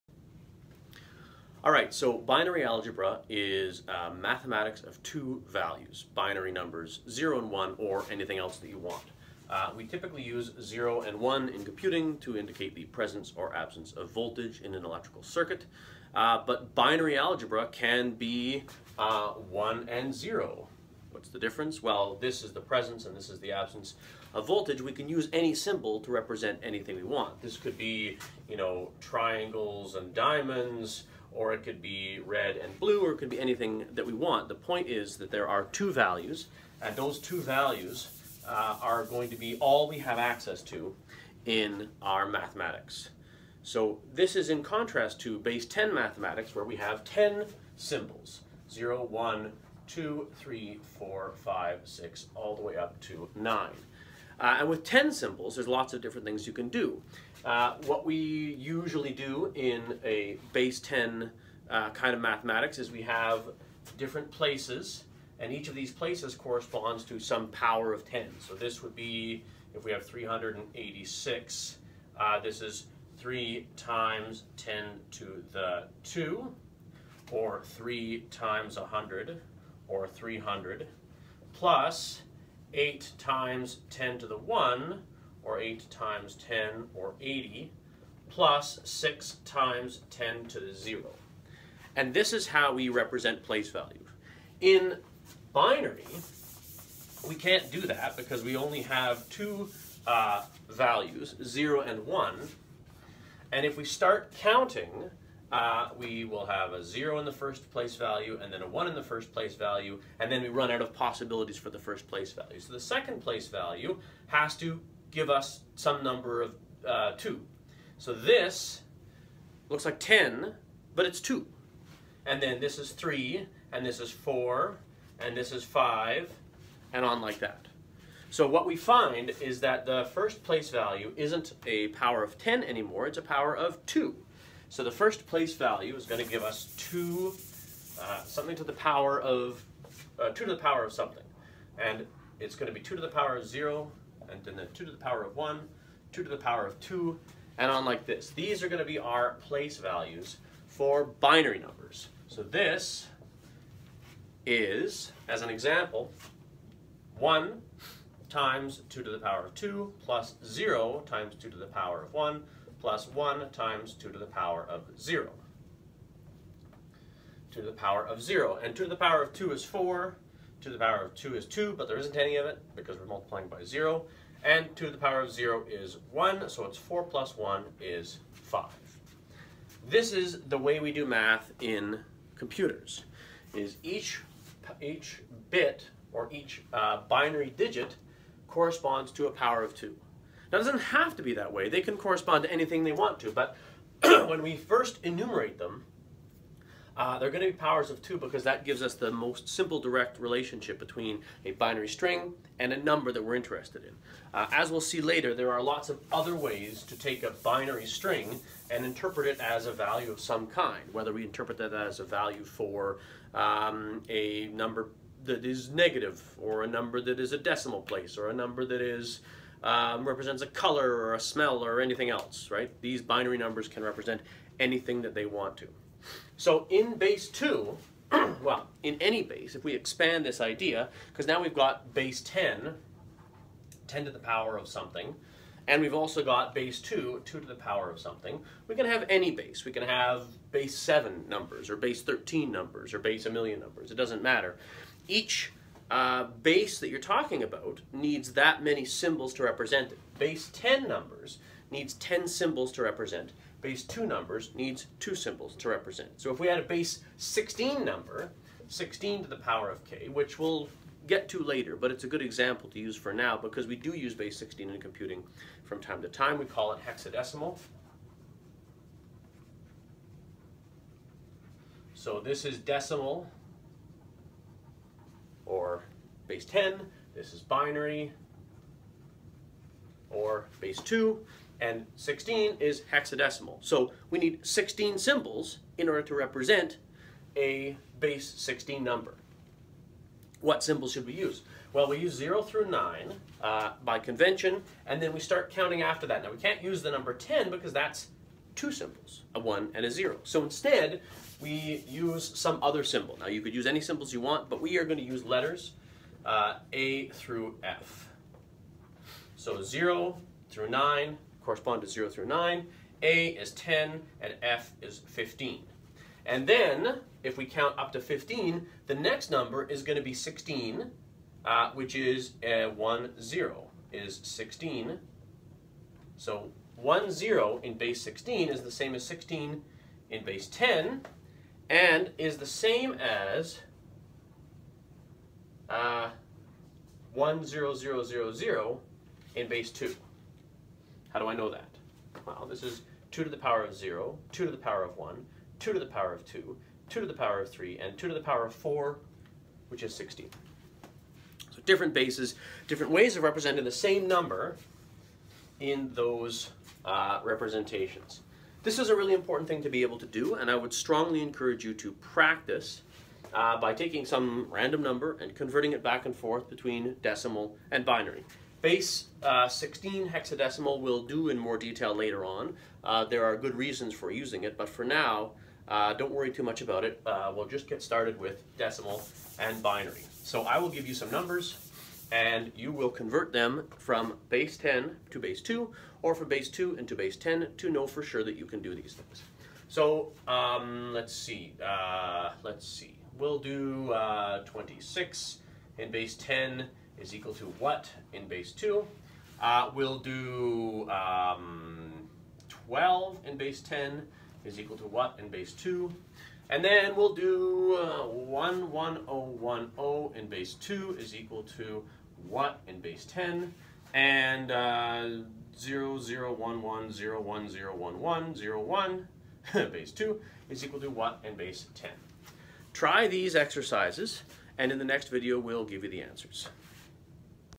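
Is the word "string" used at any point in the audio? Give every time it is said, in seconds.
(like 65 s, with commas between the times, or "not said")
201 s, 207 s.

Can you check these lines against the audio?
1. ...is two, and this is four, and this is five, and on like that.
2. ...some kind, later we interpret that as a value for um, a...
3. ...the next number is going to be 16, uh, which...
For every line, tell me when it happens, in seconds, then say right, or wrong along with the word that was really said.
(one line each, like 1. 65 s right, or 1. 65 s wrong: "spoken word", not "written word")
1. 122 s wrong: "three", not "two"
2. 210 s wrong: "whether", not "later"
3. 318 s right.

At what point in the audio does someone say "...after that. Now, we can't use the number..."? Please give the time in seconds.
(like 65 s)
295 s.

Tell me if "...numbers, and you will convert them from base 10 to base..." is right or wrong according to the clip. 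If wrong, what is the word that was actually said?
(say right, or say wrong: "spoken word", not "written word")
right.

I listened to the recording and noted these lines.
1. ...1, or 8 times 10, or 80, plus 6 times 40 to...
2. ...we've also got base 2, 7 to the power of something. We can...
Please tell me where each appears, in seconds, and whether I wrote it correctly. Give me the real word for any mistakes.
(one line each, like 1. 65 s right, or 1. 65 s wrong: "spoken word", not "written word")
1. 84 s wrong: "10", not "40"
2. 235 s wrong: "2", not "7".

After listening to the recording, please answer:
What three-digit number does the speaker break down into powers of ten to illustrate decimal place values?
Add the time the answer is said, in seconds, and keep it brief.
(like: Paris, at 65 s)
386, at 70 s.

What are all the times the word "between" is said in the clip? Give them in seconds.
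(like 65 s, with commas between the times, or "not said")
200 s, 366 s.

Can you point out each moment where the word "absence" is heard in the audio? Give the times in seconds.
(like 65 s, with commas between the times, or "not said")
13 s, 23 s.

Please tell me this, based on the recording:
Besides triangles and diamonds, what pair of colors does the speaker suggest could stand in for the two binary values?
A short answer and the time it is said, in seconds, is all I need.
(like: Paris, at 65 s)
red and blue, at 32 s.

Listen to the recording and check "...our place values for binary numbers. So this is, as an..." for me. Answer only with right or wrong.
right.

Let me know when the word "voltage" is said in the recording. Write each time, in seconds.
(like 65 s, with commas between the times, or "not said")
14 s, 24 s.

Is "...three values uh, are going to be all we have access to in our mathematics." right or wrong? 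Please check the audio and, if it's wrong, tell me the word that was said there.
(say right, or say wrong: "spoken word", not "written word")
wrong: "two", not "three".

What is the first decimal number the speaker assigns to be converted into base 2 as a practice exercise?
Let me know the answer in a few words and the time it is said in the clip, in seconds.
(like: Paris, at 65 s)
26, at 394 s.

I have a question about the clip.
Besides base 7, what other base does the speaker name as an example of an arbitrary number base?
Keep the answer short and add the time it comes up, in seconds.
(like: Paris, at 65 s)
13, at 241 s.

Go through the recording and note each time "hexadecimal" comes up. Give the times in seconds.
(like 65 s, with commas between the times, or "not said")
266 s, 282 s, 370 s.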